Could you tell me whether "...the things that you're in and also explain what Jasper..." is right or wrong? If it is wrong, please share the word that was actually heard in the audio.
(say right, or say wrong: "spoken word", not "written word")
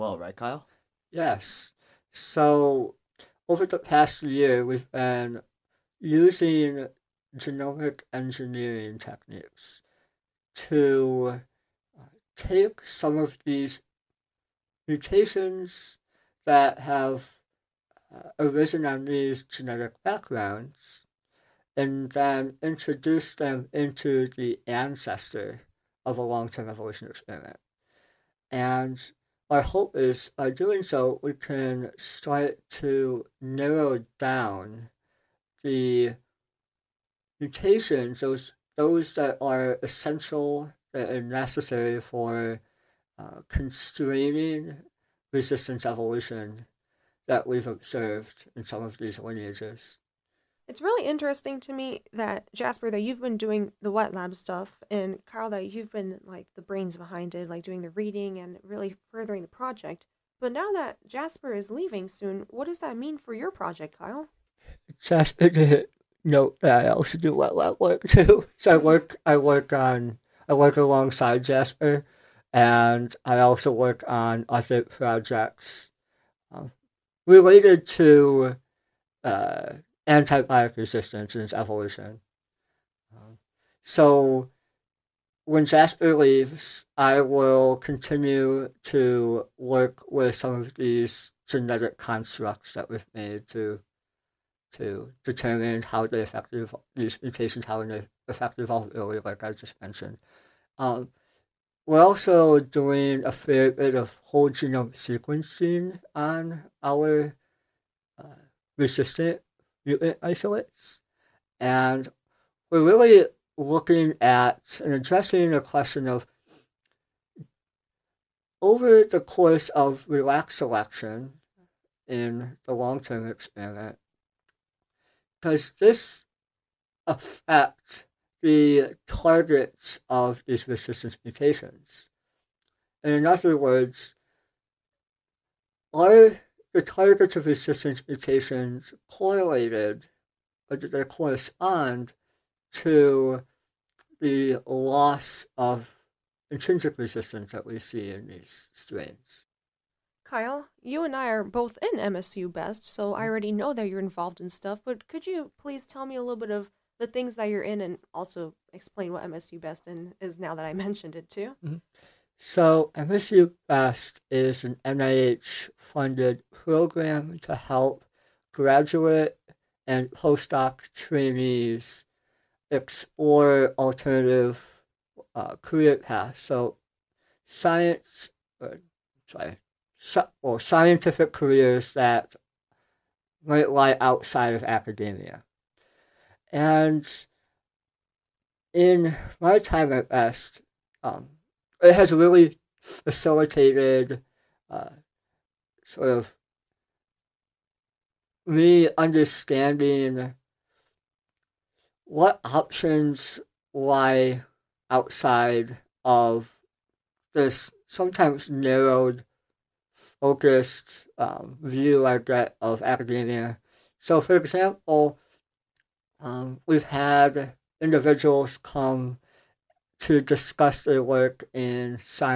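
wrong: "MSU", not "Jasper".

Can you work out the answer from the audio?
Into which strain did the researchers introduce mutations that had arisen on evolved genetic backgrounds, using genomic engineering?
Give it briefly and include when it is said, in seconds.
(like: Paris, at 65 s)
The ancestor, at 24 s.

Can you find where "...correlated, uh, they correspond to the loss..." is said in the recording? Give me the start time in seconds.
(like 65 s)
139 s.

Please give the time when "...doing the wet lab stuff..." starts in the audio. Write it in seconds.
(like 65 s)
53 s.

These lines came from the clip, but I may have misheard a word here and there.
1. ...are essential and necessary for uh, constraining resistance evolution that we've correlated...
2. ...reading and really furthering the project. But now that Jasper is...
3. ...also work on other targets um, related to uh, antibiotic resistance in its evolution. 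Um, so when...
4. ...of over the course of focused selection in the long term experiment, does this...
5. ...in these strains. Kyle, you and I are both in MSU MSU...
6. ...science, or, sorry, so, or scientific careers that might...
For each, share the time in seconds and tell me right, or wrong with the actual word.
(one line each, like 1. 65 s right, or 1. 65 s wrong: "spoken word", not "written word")
1. 39 s wrong: "observed", not "correlated"
2. 57 s right
3. 73 s wrong: "projects", not "targets"
4. 116 s wrong: "relaxed", not "focused"
5. 148 s wrong: "Best", not "MSU"
6. 177 s right.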